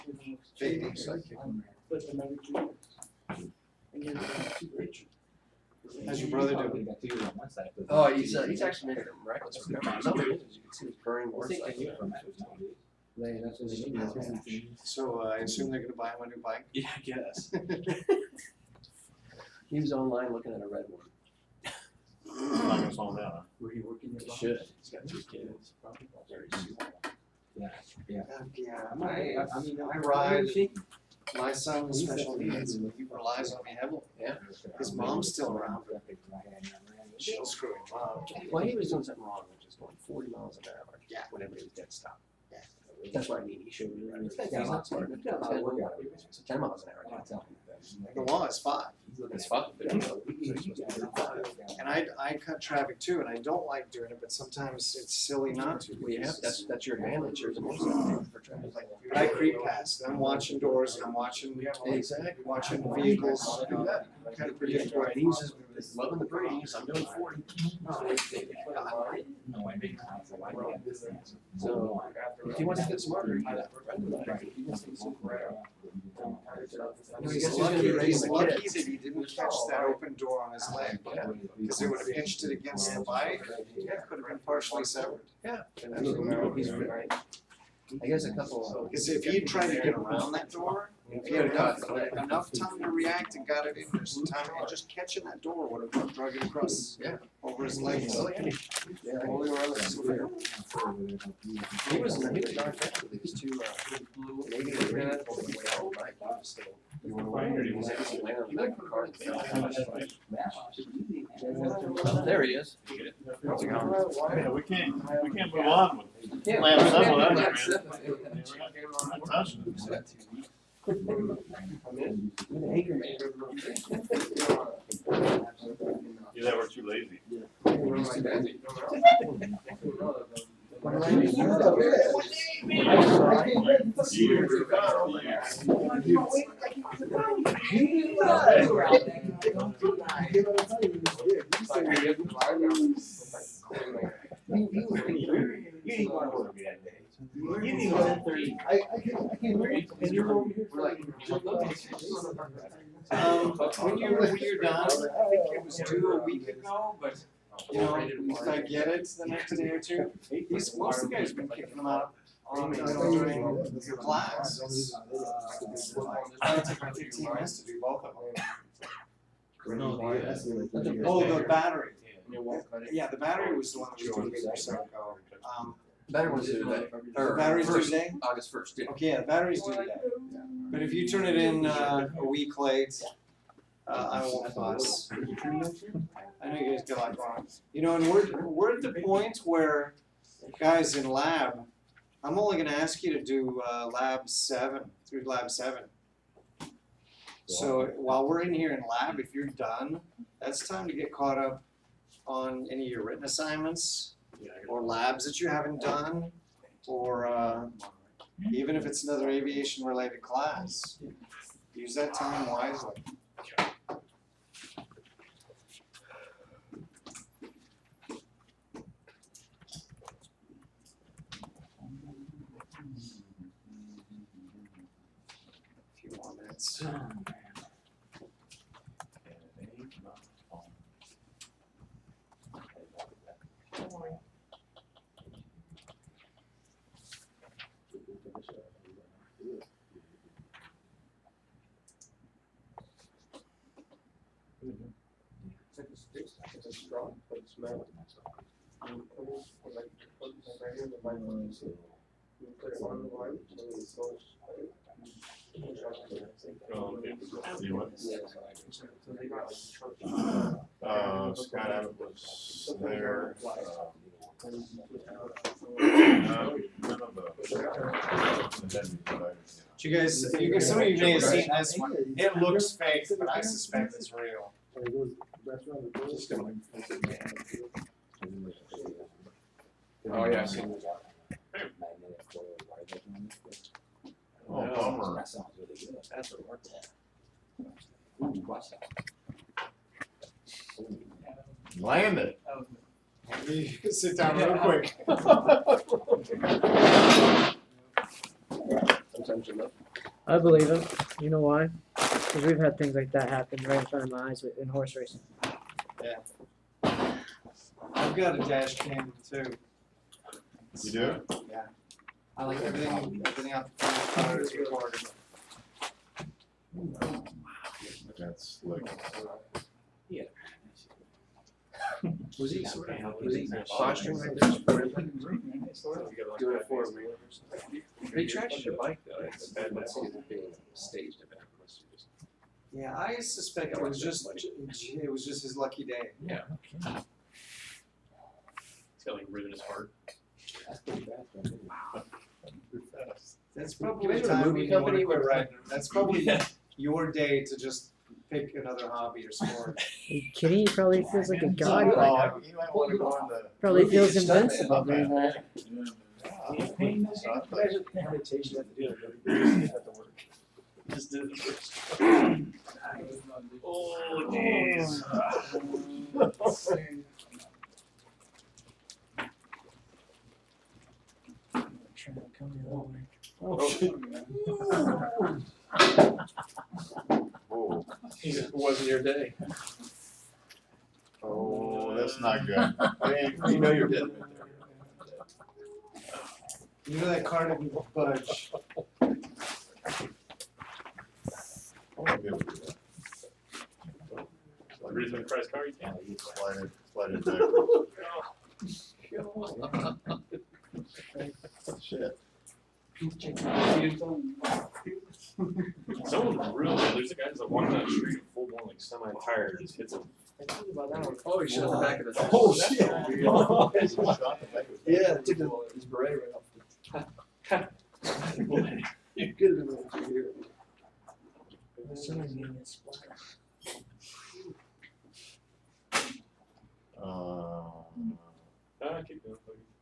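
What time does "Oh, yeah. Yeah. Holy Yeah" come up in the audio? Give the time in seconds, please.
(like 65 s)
98 s.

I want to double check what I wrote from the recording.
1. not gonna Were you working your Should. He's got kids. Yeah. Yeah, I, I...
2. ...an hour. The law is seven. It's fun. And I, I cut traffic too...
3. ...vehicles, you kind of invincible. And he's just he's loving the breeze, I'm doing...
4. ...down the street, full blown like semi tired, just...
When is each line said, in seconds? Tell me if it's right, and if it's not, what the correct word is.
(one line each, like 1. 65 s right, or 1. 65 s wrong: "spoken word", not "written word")
1. 22 s right
2. 46 s wrong: "five", not "seven"
3. 62 s wrong: "predictable", not "invincible"
4. 407 s right.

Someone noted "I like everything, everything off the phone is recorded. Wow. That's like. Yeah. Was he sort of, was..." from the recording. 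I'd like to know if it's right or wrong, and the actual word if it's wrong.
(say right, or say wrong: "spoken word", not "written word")
right.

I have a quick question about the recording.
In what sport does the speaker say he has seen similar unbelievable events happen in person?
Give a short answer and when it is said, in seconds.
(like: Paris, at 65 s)
Horse racing, at 304 s.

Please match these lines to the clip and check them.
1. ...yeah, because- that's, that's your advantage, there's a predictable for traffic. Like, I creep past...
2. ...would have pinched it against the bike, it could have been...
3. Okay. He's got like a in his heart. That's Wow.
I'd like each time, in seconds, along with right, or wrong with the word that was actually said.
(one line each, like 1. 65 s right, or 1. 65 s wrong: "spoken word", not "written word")
1. 56 s wrong: "motorcycle", not "predictable"
2. 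81 s right
3. 336 s right.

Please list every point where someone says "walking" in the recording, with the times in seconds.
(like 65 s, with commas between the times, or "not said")
407 s.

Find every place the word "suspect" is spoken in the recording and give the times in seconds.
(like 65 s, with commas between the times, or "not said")
273 s, 333 s.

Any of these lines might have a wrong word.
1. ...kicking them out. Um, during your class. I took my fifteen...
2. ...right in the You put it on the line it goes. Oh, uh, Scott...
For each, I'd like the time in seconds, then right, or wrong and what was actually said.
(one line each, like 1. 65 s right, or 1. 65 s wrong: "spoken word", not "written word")
1. 161 s right
2. 250 s right.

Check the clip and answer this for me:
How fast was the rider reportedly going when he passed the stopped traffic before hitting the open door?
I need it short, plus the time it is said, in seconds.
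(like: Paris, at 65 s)
40 miles an hour, at 40 s.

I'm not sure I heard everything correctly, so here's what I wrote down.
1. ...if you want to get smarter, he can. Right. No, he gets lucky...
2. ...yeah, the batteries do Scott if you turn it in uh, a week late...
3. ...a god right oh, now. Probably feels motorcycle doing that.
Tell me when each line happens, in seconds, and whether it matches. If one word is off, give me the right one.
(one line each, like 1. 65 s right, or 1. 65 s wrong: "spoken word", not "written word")
1. 72 s right
2. 179 s wrong: "But", not "Scott"
3. 351 s wrong: "invincible", not "motorcycle".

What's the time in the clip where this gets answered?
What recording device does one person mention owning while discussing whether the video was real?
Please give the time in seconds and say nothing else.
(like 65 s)
308 s.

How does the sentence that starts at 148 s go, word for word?
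I, I can't, I can't read.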